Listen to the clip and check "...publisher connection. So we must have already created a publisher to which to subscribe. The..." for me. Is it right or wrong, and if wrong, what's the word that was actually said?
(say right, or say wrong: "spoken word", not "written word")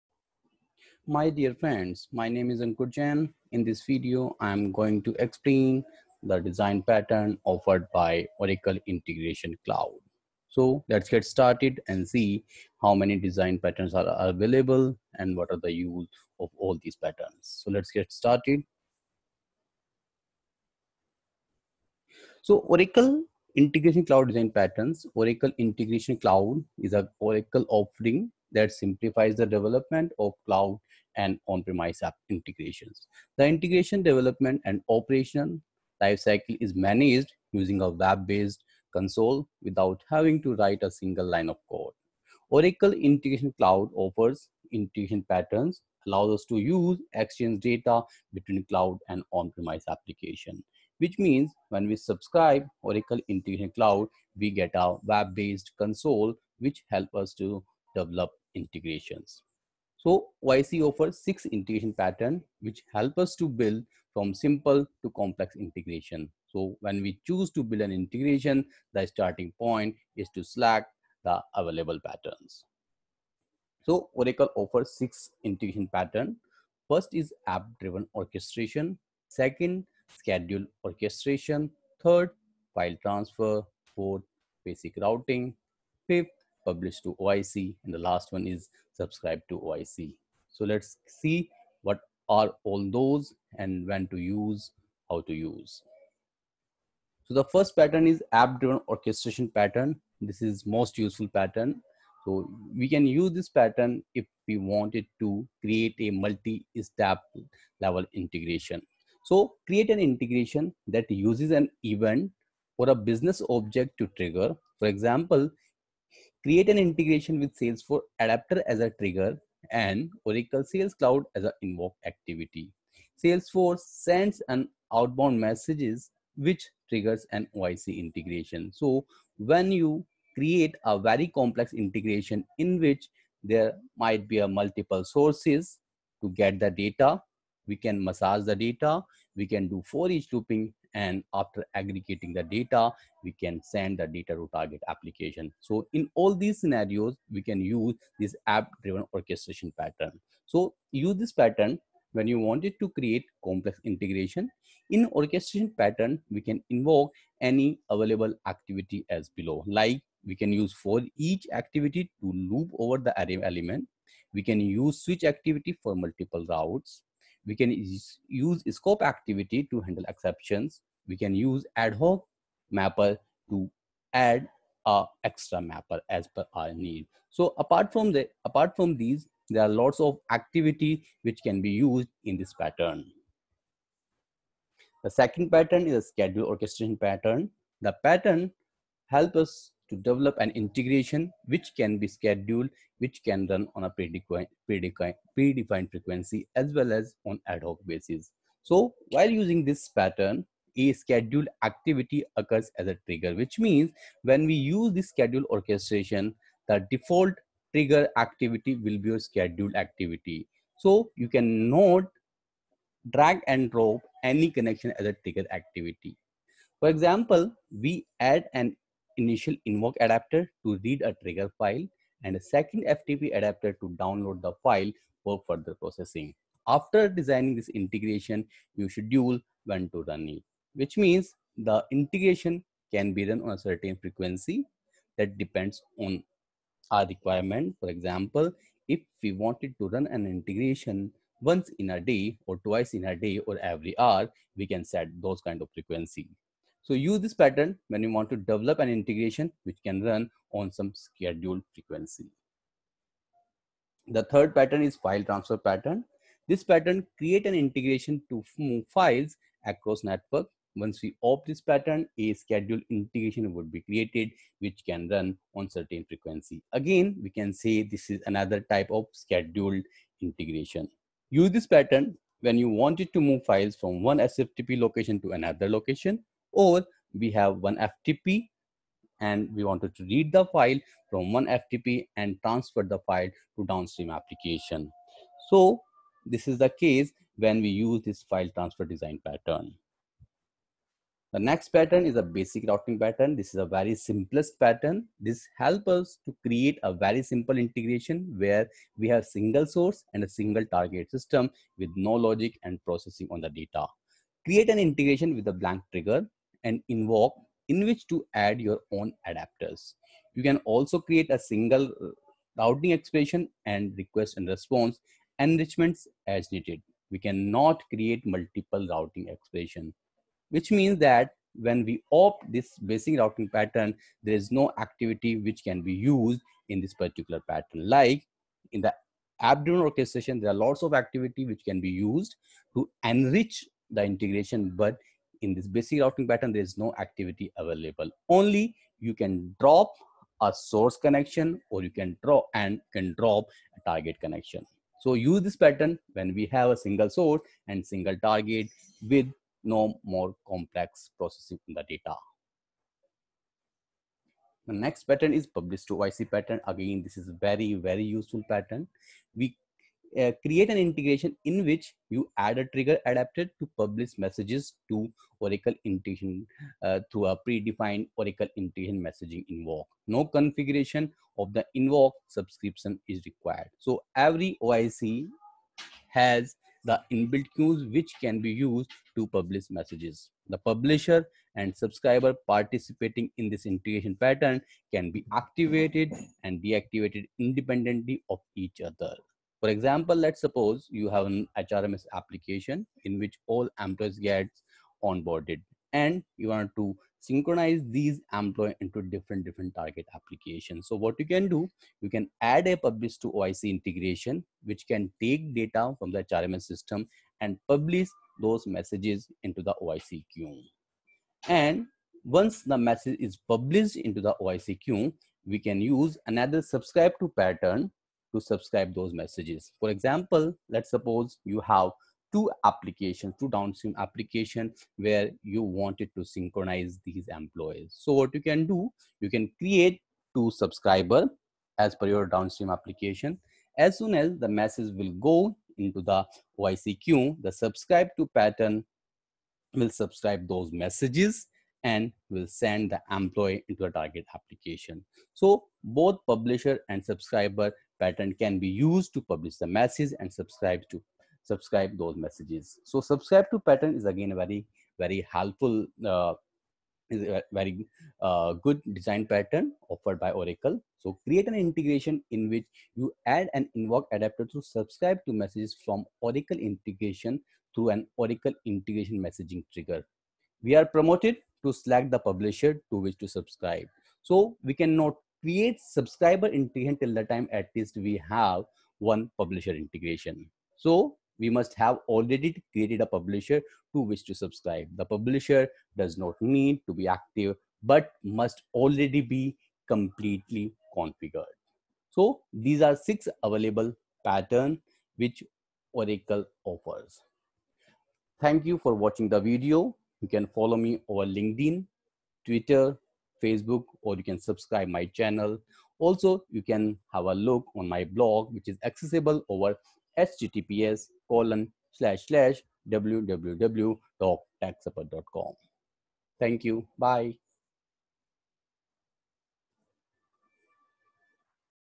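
wrong: "integration", not "connection".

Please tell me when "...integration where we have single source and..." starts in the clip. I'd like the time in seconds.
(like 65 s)
297 s.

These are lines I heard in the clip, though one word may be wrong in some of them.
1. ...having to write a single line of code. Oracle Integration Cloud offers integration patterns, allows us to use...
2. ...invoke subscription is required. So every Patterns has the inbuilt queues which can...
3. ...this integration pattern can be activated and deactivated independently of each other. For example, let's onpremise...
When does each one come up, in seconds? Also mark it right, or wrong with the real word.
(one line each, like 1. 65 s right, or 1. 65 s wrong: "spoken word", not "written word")
1. 40 s right
2. 371 s wrong: "OIC", not "Patterns"
3. 383 s wrong: "suppose", not "onpremise".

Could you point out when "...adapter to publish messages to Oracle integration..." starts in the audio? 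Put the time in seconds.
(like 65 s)
363 s.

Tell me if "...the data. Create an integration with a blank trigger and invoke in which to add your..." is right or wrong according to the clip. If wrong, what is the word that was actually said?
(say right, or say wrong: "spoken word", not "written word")
right.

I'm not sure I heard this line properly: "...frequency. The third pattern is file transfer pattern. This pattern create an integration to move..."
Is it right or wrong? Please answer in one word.
right.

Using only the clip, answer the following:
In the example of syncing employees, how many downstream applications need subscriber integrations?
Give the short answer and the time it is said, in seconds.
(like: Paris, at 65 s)
2, at 423 s.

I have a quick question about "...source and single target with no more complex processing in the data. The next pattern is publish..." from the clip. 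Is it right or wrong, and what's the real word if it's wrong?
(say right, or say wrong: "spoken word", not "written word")
right.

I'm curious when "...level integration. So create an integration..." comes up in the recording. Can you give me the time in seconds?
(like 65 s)
107 s.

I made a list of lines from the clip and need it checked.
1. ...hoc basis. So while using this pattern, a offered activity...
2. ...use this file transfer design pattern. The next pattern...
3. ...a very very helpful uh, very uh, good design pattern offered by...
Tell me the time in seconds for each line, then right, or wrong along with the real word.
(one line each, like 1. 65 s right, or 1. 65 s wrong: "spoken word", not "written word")
1. 197 s wrong: "scheduled", not "offered"
2. 287 s right
3. 454 s right.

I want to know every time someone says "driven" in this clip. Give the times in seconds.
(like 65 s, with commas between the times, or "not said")
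77 s, 98 s, 148 s, 329 s.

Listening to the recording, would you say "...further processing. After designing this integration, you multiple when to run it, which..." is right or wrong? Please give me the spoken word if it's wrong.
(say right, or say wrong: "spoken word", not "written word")
wrong: "schedule", not "multiple".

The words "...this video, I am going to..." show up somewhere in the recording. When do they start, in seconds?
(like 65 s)
3 s.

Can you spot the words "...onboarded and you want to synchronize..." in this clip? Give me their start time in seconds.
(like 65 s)
395 s.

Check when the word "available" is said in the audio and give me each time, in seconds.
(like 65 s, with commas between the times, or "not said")
14 s, 71 s, 157 s, 337 s, 493 s.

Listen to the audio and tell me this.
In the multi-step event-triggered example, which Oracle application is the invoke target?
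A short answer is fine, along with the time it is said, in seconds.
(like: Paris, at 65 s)
Oracle Sales Cloud, at 120 s.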